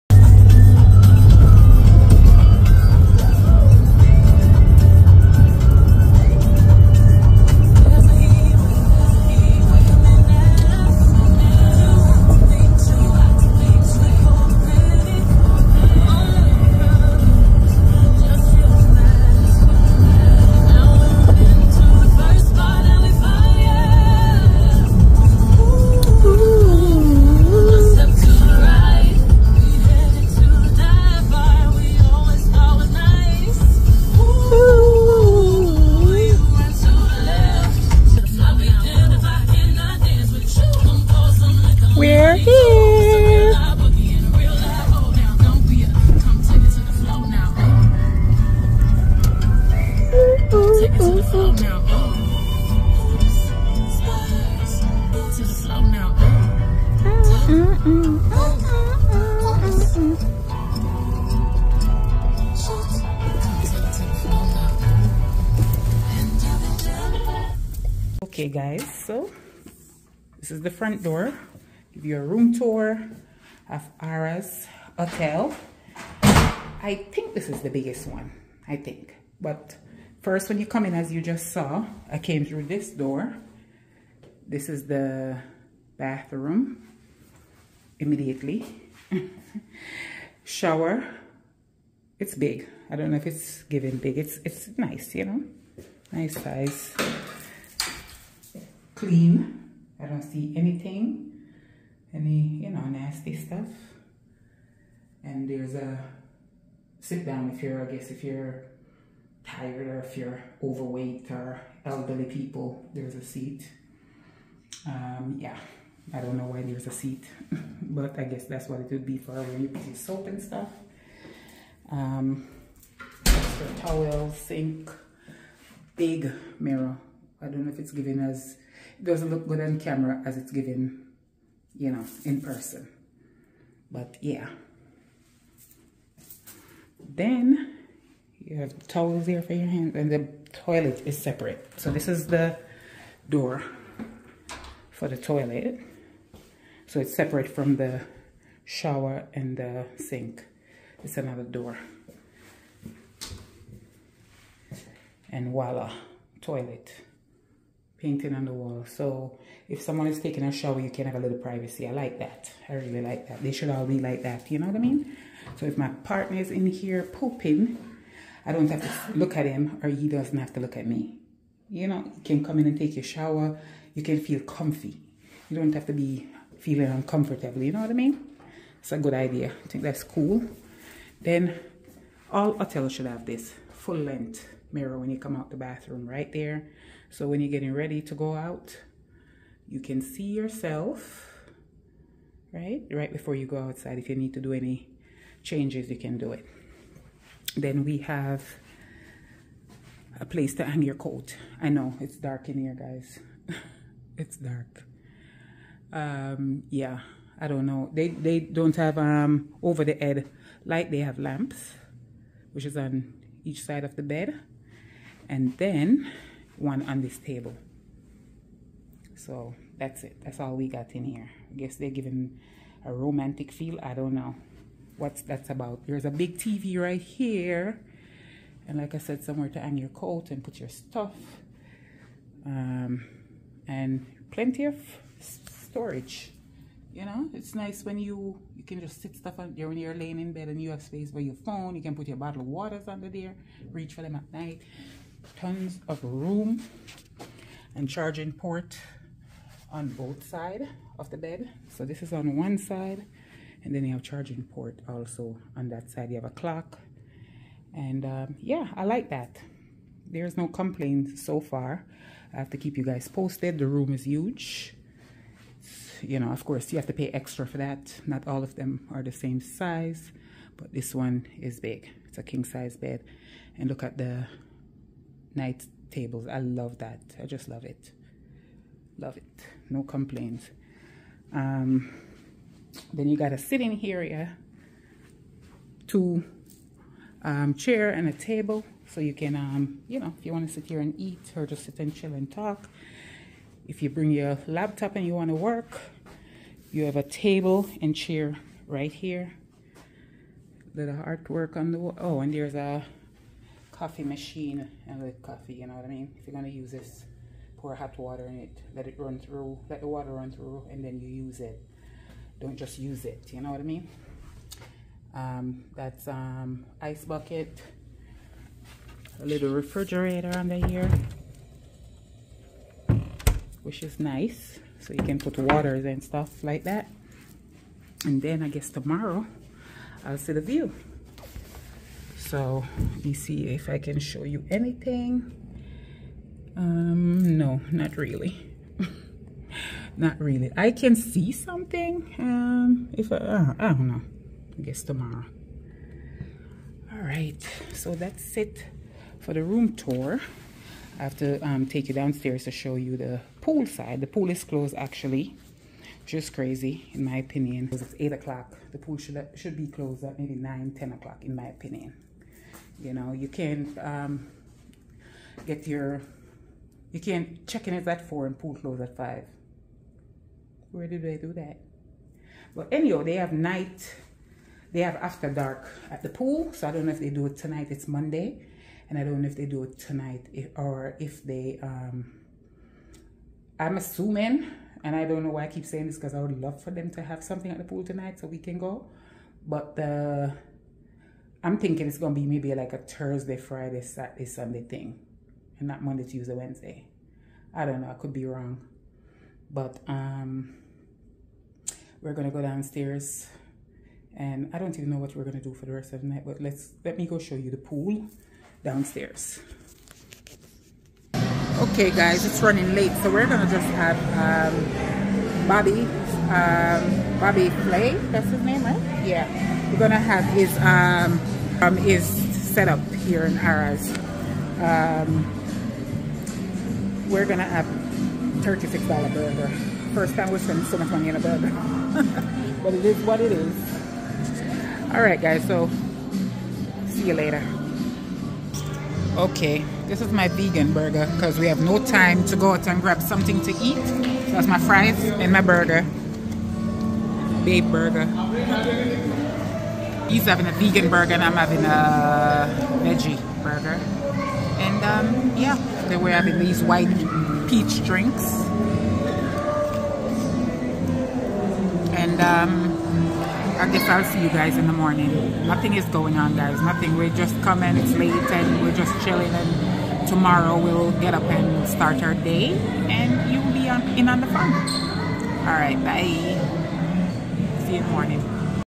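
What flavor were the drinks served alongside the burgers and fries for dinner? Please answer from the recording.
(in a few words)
white peach.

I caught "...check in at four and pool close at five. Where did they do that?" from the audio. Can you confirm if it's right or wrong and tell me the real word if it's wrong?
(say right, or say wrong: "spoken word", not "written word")
right.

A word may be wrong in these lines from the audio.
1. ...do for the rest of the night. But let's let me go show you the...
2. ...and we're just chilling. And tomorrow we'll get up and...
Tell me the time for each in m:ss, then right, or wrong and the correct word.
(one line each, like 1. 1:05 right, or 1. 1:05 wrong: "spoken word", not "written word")
1. 6:45 right
2. 7:48 right.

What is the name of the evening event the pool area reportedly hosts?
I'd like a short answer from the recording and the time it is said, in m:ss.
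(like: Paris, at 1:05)
After Dark, at 6:14.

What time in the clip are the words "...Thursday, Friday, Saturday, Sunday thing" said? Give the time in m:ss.
6:32.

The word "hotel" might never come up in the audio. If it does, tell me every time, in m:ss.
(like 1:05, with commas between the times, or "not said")
1:14, 3:02.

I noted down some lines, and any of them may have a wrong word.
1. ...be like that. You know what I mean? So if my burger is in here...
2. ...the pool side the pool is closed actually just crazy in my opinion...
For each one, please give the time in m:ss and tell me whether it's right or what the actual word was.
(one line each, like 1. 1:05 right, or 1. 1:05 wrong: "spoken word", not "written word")
1. 2:43 wrong: "partner", not "burger"
2. 5:52 right.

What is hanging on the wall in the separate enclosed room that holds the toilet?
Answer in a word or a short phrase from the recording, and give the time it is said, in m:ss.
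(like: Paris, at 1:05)
painting, at 2:38.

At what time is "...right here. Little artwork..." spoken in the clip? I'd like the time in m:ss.
4:58.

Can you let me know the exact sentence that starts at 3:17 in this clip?
Then we have a place to hang your coat.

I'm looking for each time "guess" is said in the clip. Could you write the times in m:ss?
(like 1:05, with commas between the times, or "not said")
1:47, 1:58, 3:41, 5:28, 5:44, 7:43.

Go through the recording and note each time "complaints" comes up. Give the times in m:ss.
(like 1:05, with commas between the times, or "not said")
4:20, 4:39.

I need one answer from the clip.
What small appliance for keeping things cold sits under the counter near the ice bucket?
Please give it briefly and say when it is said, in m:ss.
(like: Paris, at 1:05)
refrigerator, at 5:19.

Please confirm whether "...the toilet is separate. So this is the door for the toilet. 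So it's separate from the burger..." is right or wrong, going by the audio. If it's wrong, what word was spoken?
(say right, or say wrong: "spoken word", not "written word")
wrong: "shower", not "burger".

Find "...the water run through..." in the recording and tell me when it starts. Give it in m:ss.
5:09.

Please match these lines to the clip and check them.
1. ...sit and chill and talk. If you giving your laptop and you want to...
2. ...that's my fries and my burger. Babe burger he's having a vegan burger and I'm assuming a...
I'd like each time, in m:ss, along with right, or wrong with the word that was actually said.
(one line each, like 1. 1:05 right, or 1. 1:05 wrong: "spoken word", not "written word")
1. 4:51 wrong: "bring", not "giving"
2. 7:24 wrong: "having", not "assuming".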